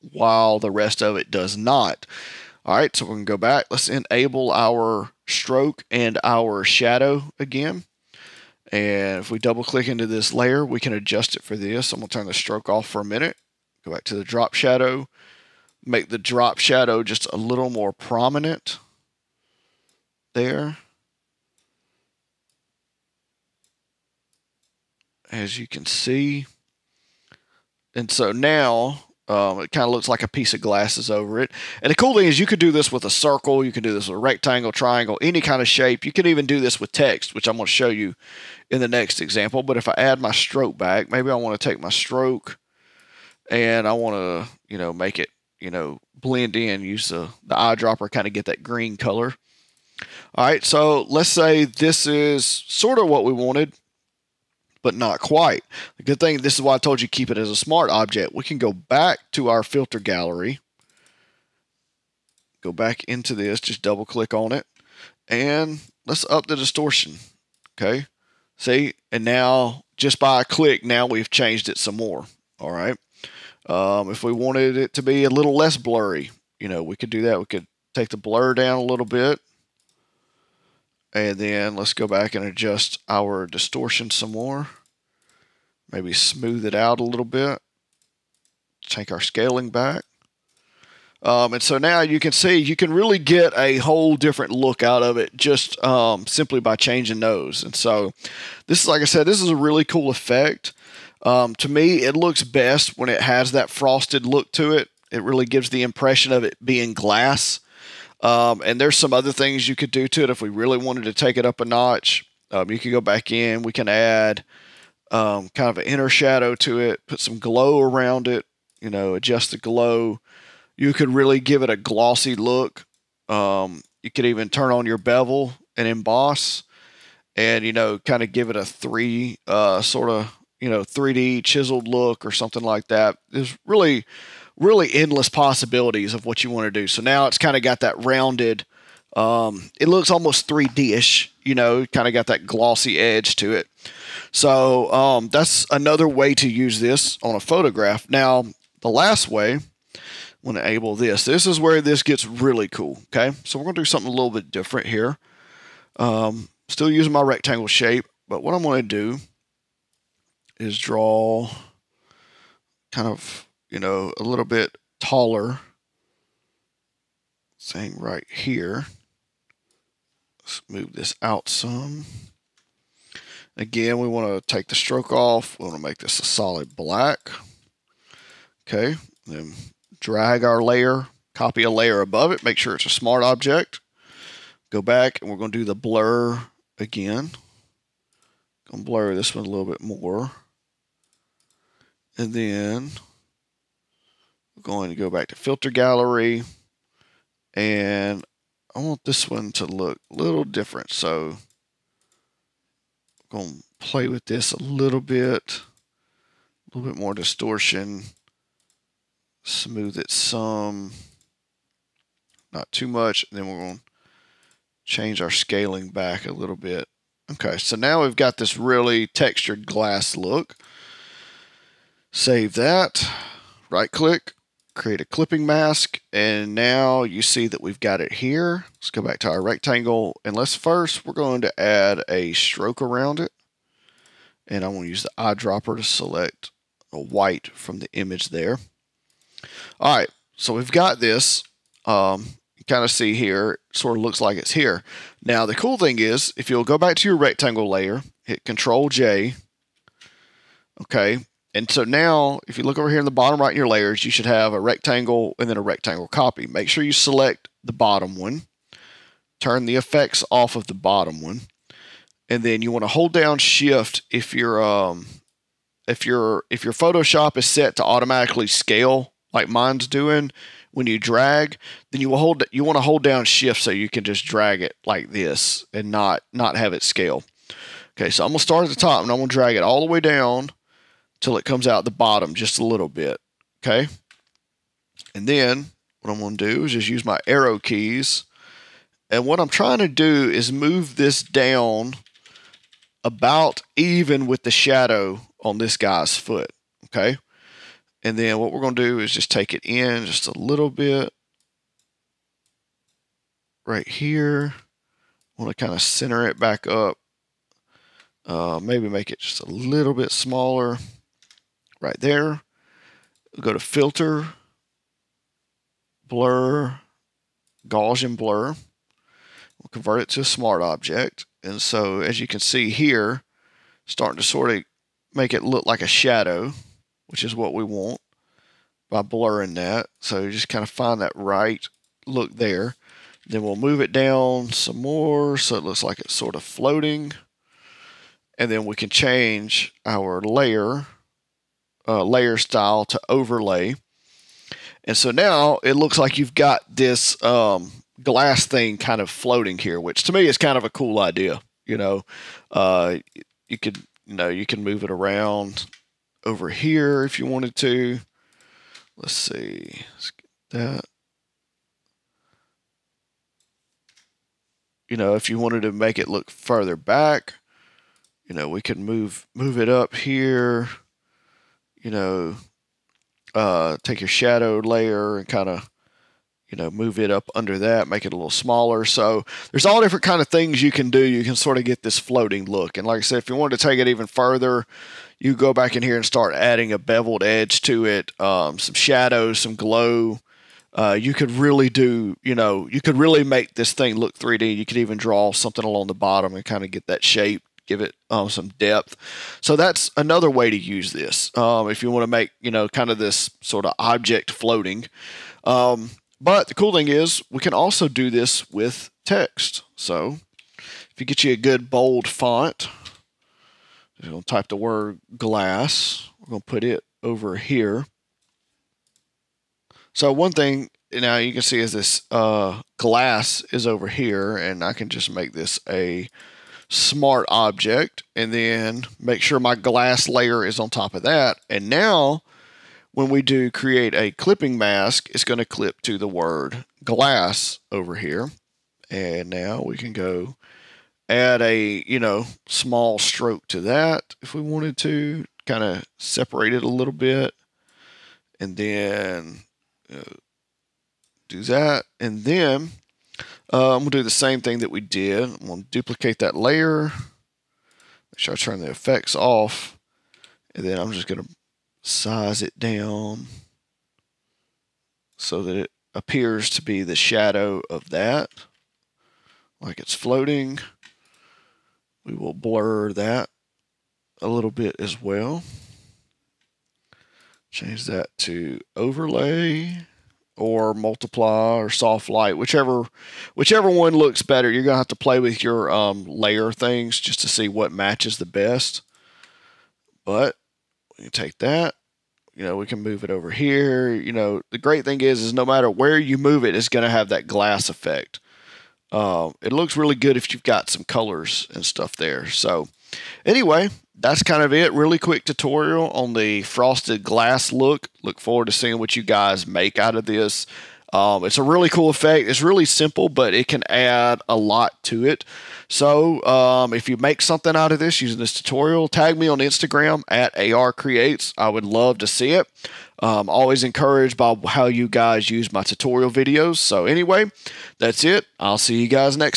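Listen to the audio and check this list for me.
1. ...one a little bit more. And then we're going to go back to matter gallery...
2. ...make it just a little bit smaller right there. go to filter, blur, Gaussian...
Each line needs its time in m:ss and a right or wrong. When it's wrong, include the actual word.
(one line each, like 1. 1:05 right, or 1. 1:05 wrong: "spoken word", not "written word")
1. 3:09 wrong: "filter", not "matter"
2. 5:08 right.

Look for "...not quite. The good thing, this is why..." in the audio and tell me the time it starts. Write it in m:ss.
0:54.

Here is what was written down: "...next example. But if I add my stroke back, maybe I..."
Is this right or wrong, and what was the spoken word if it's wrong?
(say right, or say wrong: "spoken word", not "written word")
right.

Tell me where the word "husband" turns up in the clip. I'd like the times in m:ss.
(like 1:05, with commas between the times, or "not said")
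not said.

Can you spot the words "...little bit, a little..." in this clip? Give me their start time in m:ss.
3:24.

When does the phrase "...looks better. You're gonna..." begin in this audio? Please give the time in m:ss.
8:03.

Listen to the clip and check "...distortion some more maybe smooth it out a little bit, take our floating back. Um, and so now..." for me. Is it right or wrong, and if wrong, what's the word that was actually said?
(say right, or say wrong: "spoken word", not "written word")
wrong: "scaling", not "floating".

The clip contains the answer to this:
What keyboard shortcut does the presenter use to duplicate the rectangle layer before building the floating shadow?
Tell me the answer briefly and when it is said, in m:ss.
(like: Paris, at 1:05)
Control J, at 4:08.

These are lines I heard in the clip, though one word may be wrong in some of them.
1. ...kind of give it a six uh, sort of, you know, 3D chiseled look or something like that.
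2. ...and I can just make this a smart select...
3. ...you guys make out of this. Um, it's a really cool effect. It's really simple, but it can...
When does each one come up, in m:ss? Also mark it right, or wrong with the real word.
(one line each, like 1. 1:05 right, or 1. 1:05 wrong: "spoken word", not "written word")
1. 2:07 wrong: "three", not "six"
2. 7:04 wrong: "object", not "select"
3. 8:28 right.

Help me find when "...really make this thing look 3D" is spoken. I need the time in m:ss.
6:32.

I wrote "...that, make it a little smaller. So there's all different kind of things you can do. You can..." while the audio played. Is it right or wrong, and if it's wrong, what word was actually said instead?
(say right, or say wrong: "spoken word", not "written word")
right.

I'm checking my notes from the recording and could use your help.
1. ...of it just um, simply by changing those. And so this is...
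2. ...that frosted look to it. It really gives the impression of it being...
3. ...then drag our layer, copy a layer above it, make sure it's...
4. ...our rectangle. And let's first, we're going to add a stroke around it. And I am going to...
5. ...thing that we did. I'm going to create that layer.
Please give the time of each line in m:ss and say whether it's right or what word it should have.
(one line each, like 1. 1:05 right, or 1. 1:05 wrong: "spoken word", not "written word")
1. 1:35 right
2. 1:43 right
3. 2:59 right
4. 3:49 right
5. 7:34 wrong: "duplicate", not "create".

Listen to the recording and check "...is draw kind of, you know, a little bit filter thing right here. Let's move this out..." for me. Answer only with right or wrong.
wrong.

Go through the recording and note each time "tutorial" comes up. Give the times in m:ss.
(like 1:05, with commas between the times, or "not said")
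8:25, 8:38, 8:45.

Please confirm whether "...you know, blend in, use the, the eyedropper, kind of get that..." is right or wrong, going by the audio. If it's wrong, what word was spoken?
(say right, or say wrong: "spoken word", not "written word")
right.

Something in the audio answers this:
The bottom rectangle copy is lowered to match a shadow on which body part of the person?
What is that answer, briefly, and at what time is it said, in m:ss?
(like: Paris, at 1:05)
foot, at 4:56.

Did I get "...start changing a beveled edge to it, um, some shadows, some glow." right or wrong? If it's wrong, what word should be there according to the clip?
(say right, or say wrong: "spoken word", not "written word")
wrong: "adding", not "changing".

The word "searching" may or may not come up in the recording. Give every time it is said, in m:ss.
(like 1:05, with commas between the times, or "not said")
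not said.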